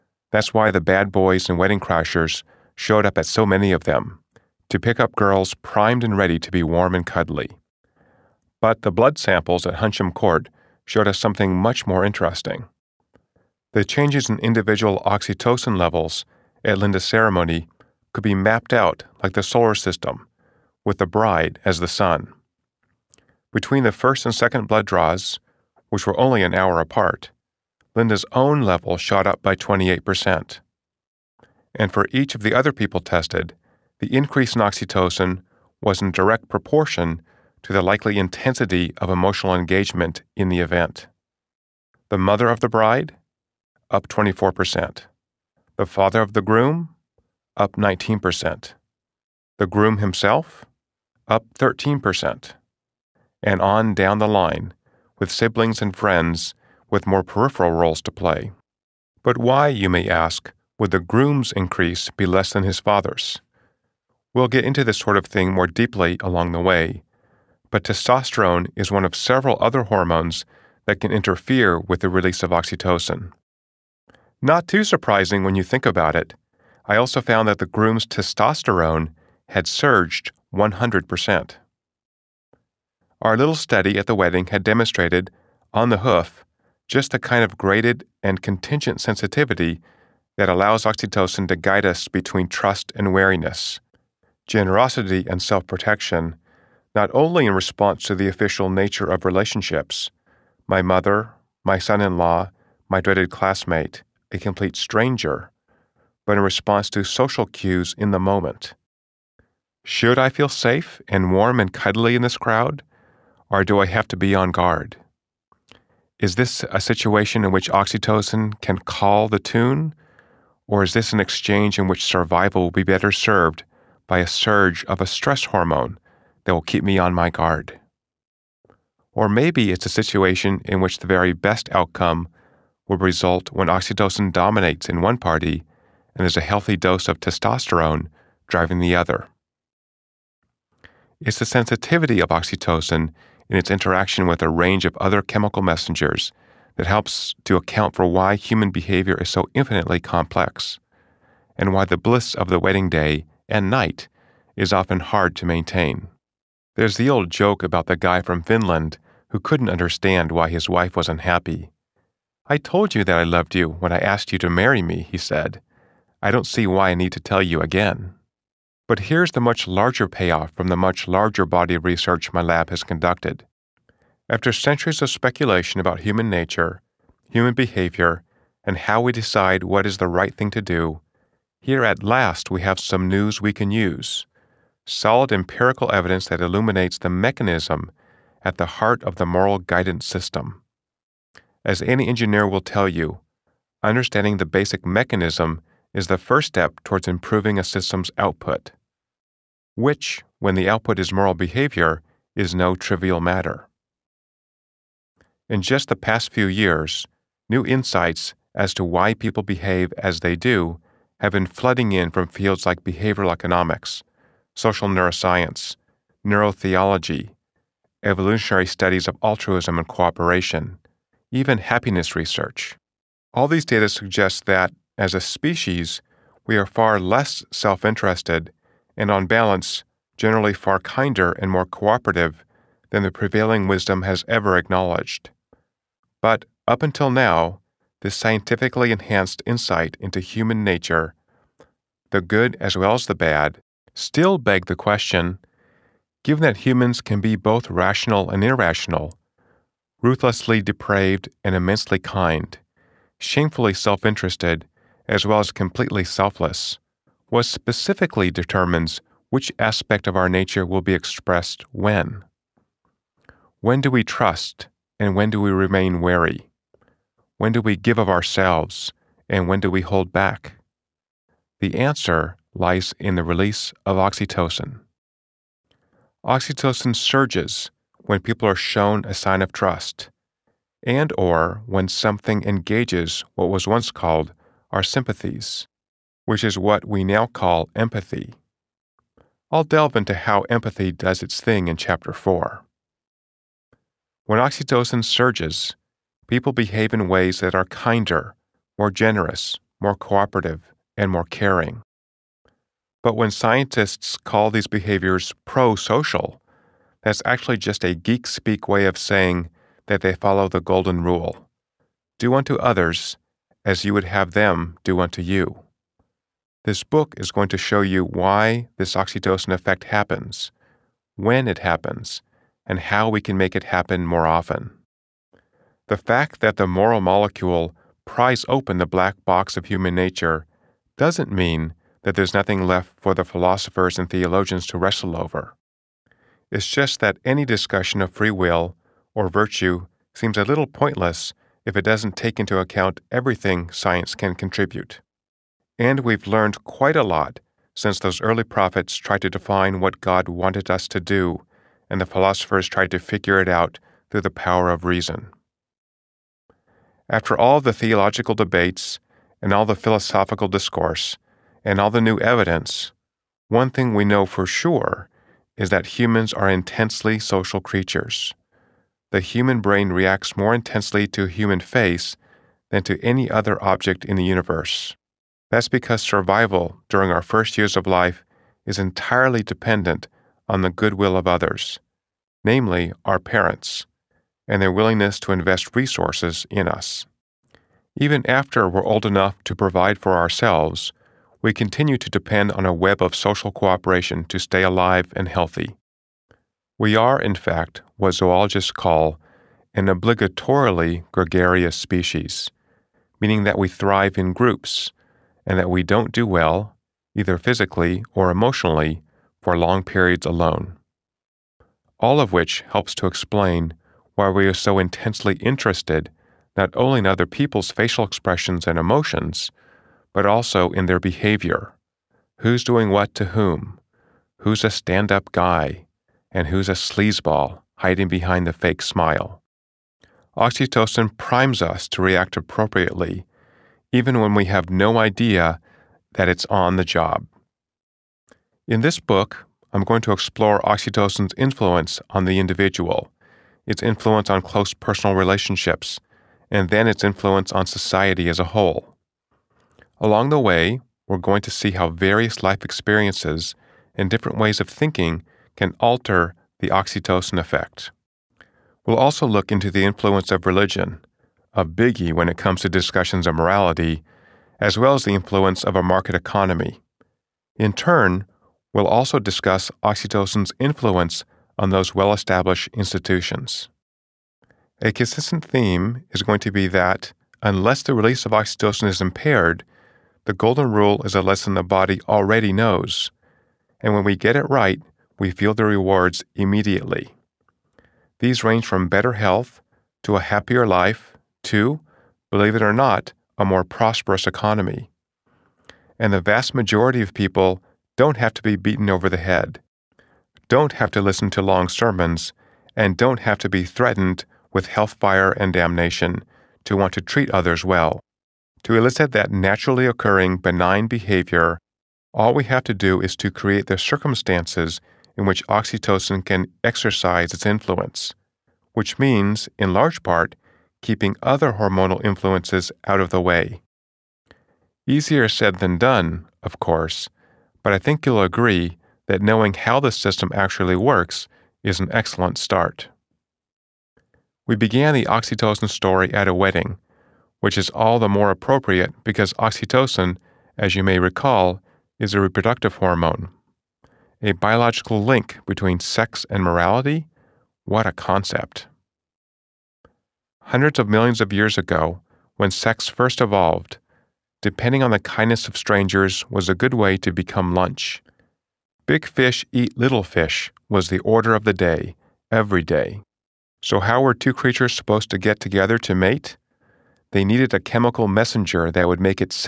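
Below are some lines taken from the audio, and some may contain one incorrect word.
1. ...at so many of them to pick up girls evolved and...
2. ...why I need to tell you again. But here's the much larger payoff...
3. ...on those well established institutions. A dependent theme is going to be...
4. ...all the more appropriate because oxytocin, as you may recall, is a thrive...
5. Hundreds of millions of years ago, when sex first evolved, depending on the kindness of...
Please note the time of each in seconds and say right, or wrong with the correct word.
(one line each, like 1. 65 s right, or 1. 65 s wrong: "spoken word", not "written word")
1. 3 s wrong: "primed", not "evolved"
2. 166 s right
3. 471 s wrong: "consistent", not "dependent"
4. 537 s wrong: "reproductive", not "thrive"
5. 550 s right.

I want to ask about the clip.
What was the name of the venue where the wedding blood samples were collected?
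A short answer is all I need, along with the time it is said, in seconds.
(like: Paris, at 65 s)
Huntsham Court, at 9 s.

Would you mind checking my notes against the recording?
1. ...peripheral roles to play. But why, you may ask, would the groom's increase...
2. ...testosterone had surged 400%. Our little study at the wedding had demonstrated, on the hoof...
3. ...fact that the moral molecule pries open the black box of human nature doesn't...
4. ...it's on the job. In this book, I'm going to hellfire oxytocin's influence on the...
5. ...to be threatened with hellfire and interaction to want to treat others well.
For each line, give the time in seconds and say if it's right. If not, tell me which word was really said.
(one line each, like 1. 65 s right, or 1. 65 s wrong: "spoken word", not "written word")
1. 57 s right
2. 78 s wrong: "100", not "400"
3. 325 s right
4. 436 s wrong: "explore", not "hellfire"
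5. 503 s wrong: "damnation", not "interaction".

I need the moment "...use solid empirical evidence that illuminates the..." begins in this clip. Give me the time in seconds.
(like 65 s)
183 s.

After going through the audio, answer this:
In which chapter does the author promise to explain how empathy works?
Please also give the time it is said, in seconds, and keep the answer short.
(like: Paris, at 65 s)
Chapter 4, at 291 s.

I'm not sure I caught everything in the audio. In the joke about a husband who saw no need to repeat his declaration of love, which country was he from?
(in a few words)
Finland.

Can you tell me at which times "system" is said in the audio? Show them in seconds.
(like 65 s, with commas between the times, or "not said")
19 s, 190 s, 197 s, 529 s.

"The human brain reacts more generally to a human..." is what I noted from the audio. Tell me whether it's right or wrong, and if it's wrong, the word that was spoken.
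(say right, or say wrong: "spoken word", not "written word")
wrong: "intensely", not "generally".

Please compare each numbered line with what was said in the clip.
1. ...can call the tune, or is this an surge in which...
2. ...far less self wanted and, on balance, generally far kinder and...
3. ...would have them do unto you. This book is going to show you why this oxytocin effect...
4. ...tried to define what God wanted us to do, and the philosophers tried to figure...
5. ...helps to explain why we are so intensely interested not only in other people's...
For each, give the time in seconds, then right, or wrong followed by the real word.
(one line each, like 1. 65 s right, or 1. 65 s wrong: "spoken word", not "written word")
1. 118 s wrong: "exchange", not "surge"
2. 226 s wrong: "interested", not "wanted"
3. 313 s right
4. 348 s right
5. 412 s right.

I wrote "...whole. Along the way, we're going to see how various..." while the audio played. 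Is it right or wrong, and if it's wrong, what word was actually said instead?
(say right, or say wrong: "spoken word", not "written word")
right.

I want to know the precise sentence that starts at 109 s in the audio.
Should I feel safe and warm and cuddly in this crowd, or do I have to be on guard?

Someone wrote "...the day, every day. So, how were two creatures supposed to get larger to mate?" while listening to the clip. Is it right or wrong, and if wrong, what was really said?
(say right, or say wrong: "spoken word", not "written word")
wrong: "together", not "larger".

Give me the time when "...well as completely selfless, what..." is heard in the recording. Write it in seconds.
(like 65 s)
255 s.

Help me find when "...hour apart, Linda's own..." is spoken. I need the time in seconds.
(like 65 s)
26 s.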